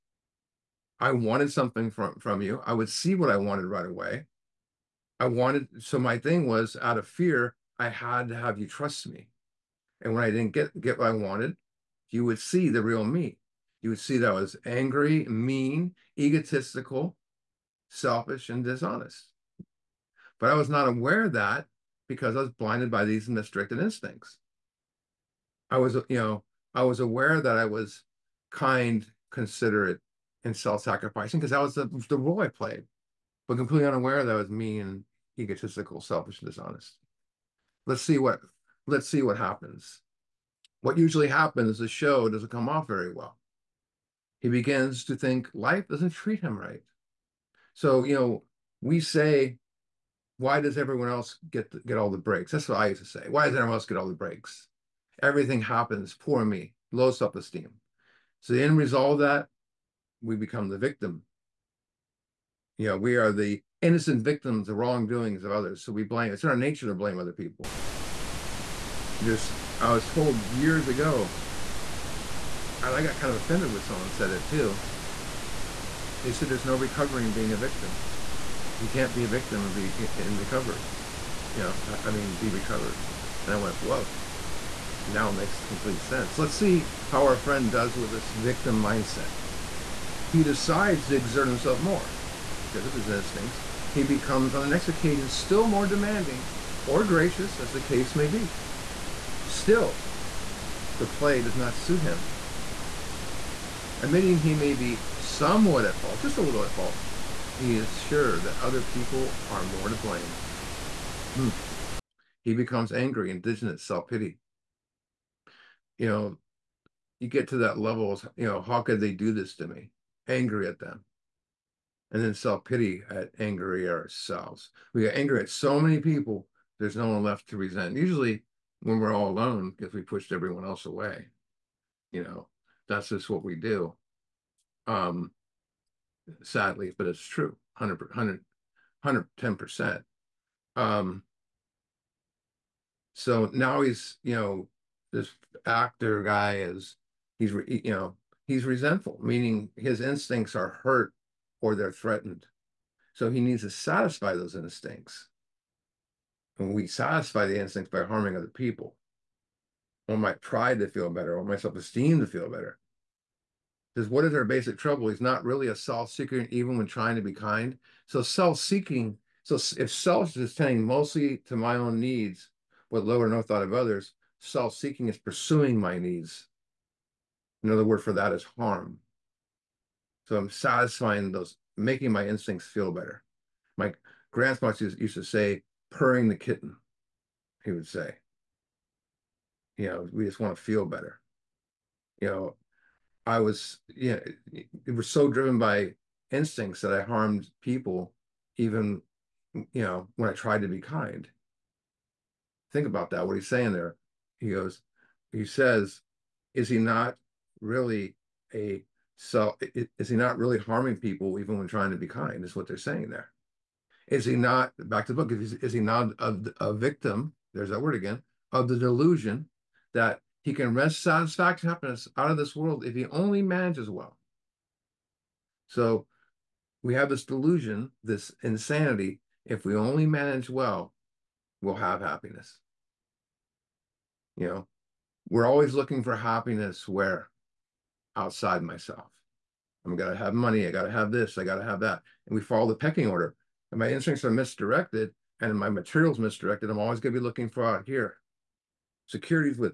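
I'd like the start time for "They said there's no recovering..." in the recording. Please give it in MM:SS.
01:16.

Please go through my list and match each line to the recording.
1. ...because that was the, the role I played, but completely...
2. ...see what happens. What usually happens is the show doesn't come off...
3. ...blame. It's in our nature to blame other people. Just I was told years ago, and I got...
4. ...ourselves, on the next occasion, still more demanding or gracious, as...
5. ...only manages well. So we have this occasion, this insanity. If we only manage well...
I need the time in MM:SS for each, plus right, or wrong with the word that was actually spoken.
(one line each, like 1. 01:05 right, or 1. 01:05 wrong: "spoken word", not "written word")
1. 00:31 right
2. 00:39 right
3. 01:06 right
4. 01:34 wrong: "becomes", not "ourselves"
5. 03:43 wrong: "delusion", not "occasion".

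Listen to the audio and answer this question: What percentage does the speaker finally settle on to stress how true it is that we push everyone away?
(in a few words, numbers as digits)
110%.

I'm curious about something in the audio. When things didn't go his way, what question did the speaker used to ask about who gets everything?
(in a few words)
Why does everyone else get all the breaks?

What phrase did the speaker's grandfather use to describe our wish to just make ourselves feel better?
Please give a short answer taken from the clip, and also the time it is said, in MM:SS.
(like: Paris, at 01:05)
Purring the kitten, at 03:05.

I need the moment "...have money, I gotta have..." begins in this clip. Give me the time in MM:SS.
04:00.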